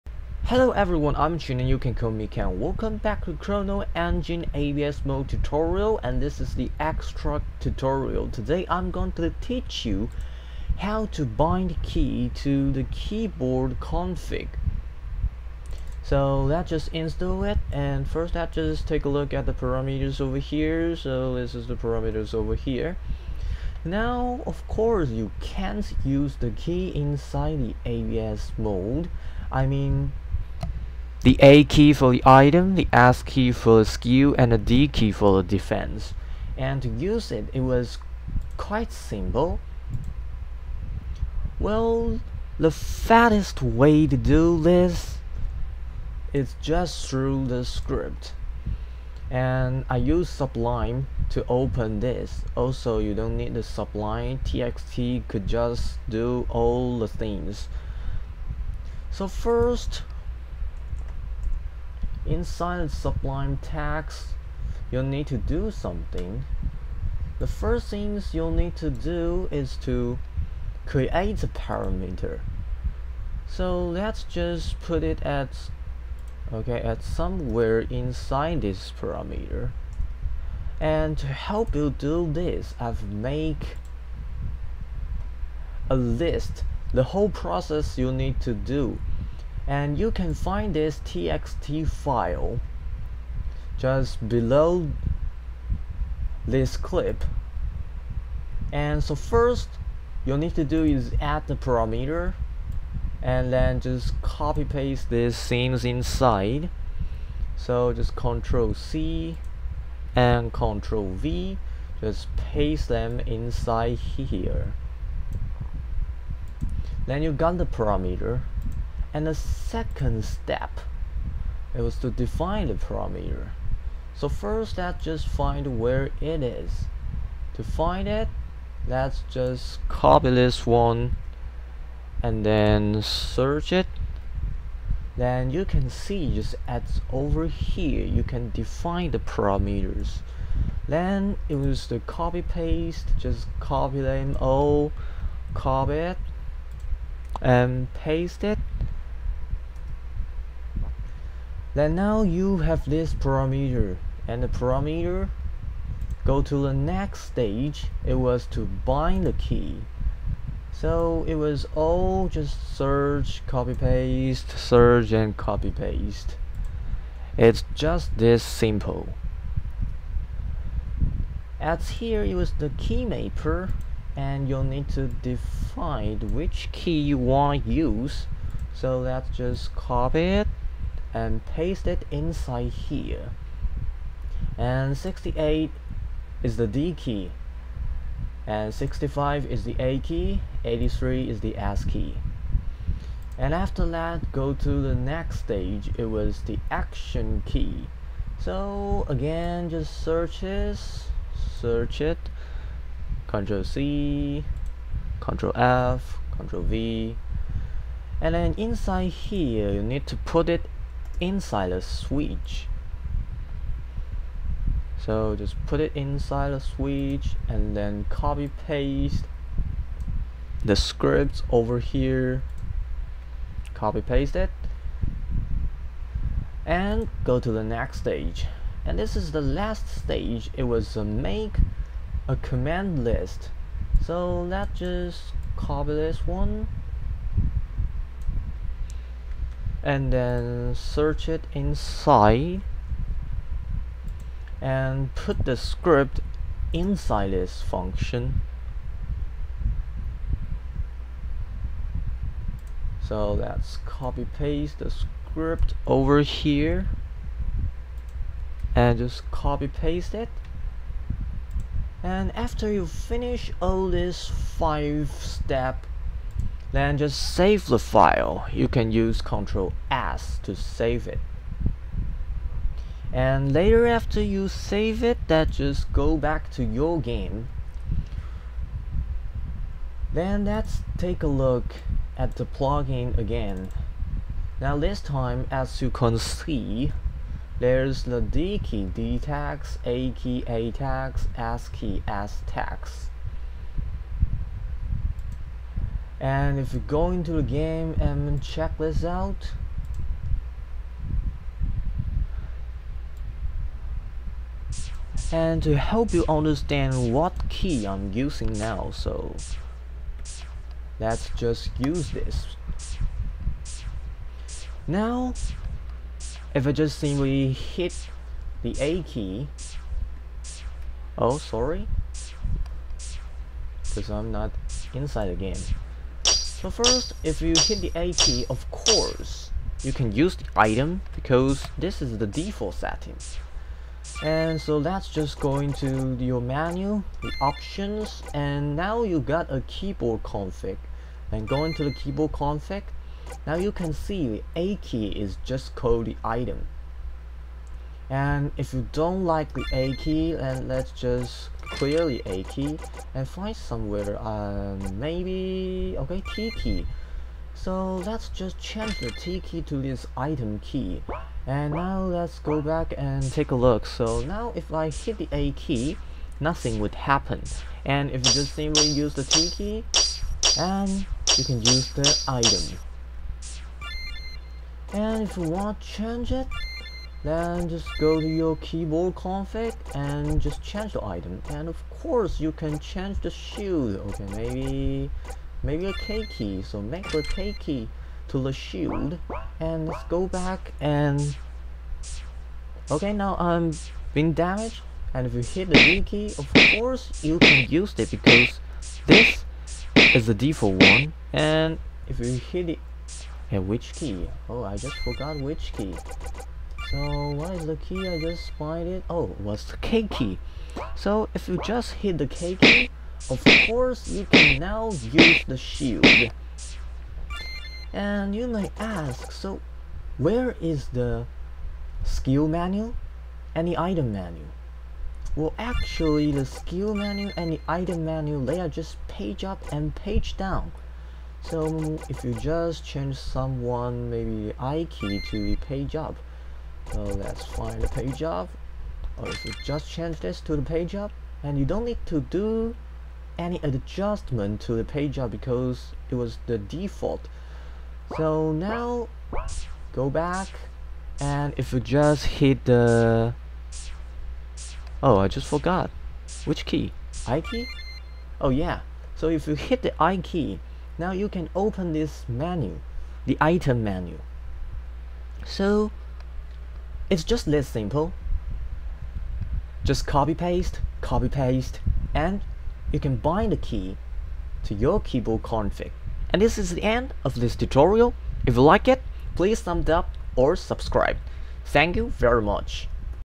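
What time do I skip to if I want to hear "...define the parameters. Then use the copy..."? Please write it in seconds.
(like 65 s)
138 s.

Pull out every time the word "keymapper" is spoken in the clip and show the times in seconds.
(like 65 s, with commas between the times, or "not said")
172 s.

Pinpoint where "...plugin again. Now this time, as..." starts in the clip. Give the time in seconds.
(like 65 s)
282 s.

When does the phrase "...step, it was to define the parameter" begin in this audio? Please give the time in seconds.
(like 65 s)
120 s.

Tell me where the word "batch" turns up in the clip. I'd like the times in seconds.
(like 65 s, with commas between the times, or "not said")
not said.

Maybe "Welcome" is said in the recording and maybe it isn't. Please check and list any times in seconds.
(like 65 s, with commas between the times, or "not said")
2 s.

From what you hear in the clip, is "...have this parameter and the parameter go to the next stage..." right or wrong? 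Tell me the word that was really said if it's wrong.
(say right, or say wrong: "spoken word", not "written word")
right.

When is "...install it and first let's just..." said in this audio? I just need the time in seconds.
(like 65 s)
16 s.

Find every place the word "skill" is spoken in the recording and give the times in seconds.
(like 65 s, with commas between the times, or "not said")
33 s, 422 s, 426 s.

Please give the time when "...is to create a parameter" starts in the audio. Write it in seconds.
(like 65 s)
69 s.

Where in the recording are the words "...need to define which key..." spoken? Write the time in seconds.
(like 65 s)
174 s.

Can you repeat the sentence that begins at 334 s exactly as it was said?
And so that's just going to your menu, the options, and now you got a keyboard config.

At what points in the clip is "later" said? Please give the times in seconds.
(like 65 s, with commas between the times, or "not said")
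273 s.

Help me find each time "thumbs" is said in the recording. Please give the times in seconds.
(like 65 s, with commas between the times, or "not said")
479 s.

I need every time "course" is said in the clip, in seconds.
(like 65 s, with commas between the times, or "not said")
24 s, 328 s, 382 s, 396 s, 413 s.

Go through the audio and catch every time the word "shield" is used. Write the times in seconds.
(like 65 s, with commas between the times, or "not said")
383 s, 388 s, 415 s.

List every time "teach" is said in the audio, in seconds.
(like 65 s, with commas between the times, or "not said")
9 s.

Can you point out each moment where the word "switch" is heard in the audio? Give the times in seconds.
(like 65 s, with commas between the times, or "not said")
211 s, 216 s.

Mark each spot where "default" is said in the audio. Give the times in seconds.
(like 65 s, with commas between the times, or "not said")
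332 s, 400 s, 446 s.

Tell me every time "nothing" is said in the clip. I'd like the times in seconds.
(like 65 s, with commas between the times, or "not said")
366 s.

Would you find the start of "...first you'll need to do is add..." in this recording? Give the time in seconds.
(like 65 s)
99 s.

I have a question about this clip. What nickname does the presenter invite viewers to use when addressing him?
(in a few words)
Ken.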